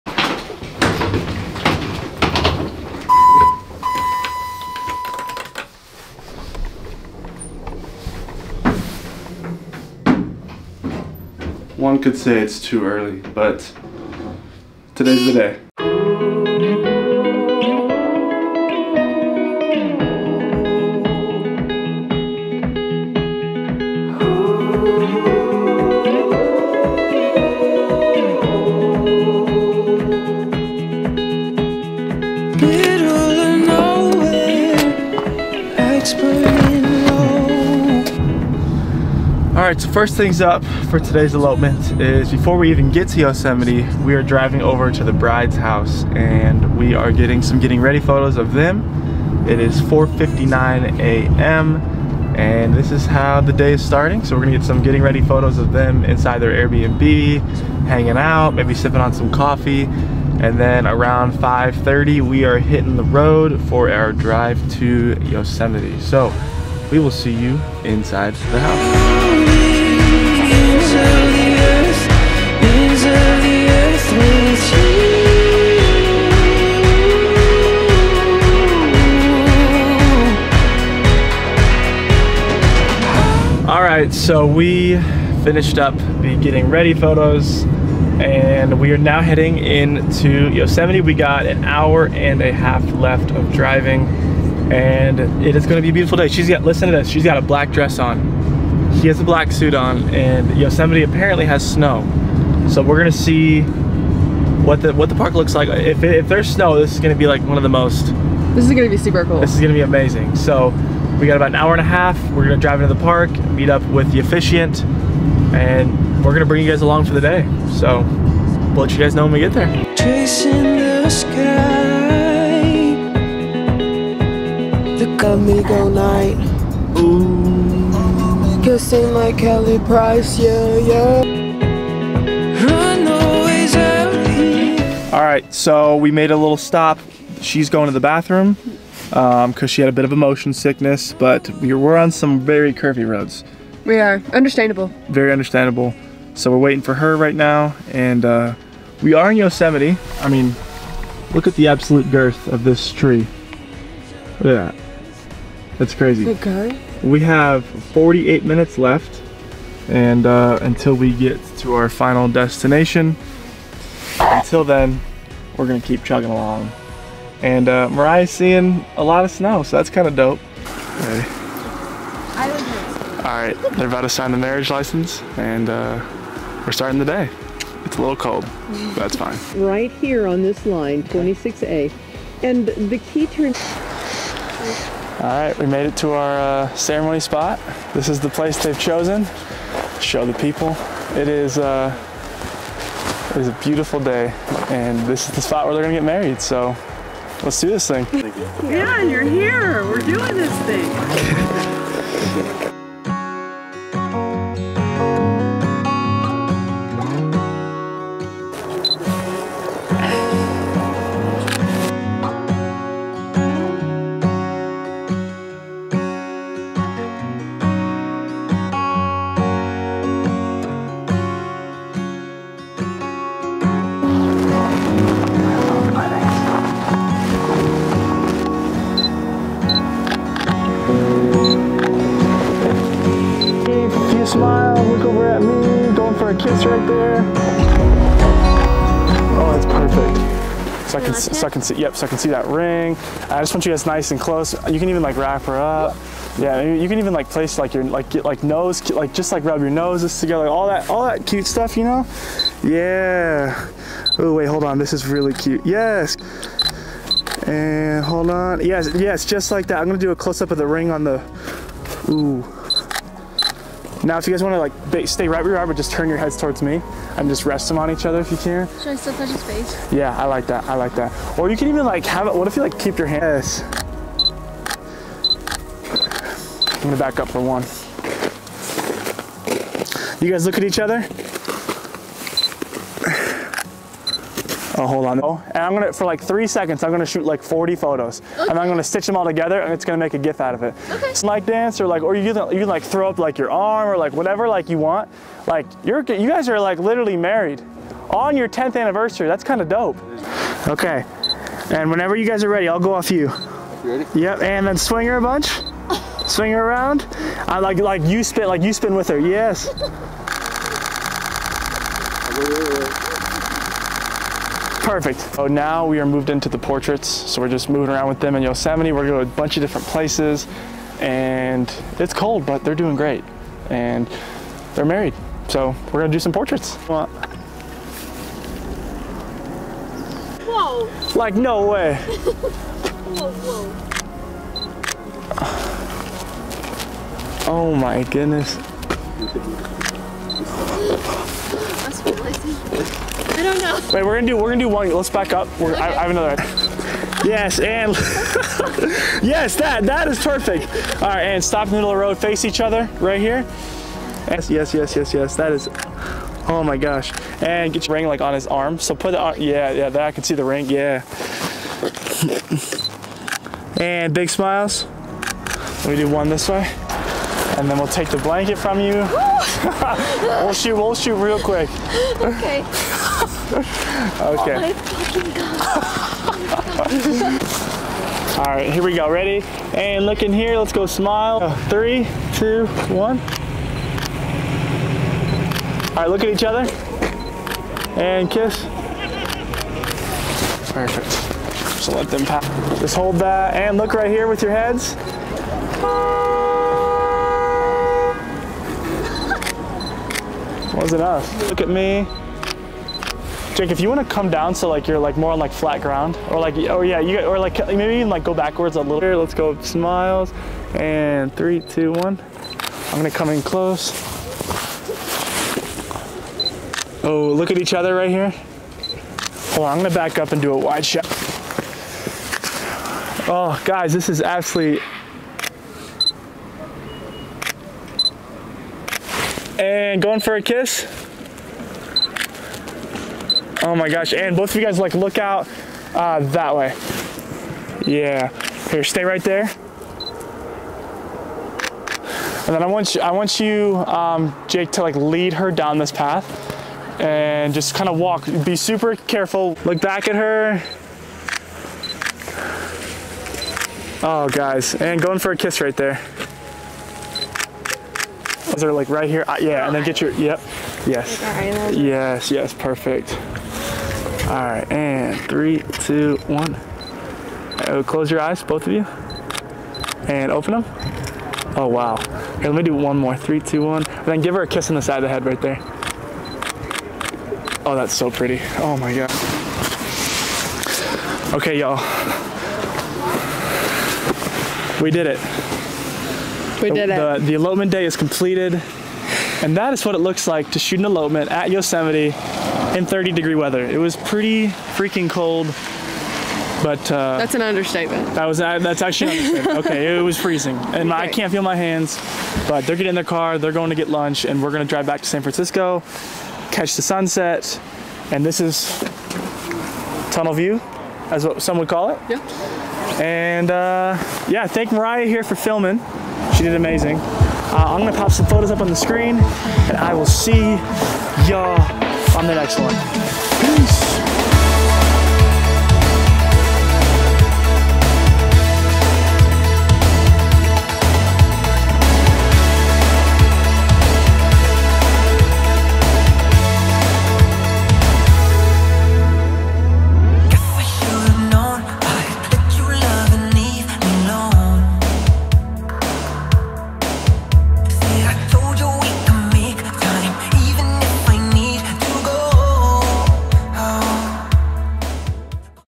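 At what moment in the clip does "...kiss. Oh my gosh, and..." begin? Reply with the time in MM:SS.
07:10.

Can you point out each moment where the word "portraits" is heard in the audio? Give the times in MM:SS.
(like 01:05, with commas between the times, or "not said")
05:16, 05:26.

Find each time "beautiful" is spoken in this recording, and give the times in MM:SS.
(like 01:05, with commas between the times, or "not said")
01:35, 03:13.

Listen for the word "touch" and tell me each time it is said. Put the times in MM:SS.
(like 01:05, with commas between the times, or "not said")
04:29.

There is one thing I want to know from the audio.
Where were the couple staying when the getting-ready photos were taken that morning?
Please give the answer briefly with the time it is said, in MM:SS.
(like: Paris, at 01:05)
Airbnb, at 00:56.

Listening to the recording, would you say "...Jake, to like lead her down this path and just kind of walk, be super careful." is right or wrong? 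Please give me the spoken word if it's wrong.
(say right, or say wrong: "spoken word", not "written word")
right.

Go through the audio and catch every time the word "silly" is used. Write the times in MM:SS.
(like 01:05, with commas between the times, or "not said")
not said.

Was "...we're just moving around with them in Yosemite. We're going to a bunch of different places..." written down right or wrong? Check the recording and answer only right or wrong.
right.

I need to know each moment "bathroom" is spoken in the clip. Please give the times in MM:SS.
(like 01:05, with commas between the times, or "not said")
02:17.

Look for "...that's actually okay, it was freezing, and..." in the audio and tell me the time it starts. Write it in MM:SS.
08:18.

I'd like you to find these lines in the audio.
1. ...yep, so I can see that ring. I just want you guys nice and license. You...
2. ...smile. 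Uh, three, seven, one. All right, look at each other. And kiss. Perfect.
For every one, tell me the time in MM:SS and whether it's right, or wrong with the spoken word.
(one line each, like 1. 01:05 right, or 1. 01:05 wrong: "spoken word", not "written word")
1. 04:01 wrong: "close", not "license"
2. 06:20 wrong: "two", not "seven".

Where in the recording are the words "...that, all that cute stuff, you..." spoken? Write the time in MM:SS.
04:10.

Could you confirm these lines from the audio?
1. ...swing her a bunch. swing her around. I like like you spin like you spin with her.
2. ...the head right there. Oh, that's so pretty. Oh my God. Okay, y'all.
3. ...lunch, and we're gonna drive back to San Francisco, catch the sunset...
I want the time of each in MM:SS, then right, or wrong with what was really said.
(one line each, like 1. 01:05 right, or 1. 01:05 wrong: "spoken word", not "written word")
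1. 05:04 right
2. 07:55 right
3. 08:23 right.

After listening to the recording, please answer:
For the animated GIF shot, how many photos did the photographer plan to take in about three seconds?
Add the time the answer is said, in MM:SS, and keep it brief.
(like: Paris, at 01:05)
40, at 04:47.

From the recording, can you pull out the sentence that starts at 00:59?
And then around 5.30, we are hitting the road for our drive to Yosemite.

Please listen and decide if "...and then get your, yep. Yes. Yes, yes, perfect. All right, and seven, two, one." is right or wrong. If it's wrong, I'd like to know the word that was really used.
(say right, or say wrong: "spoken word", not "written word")
wrong: "three", not "seven".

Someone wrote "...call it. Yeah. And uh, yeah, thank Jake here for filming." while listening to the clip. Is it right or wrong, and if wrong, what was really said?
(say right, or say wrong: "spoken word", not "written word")
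wrong: "Mariah", not "Jake".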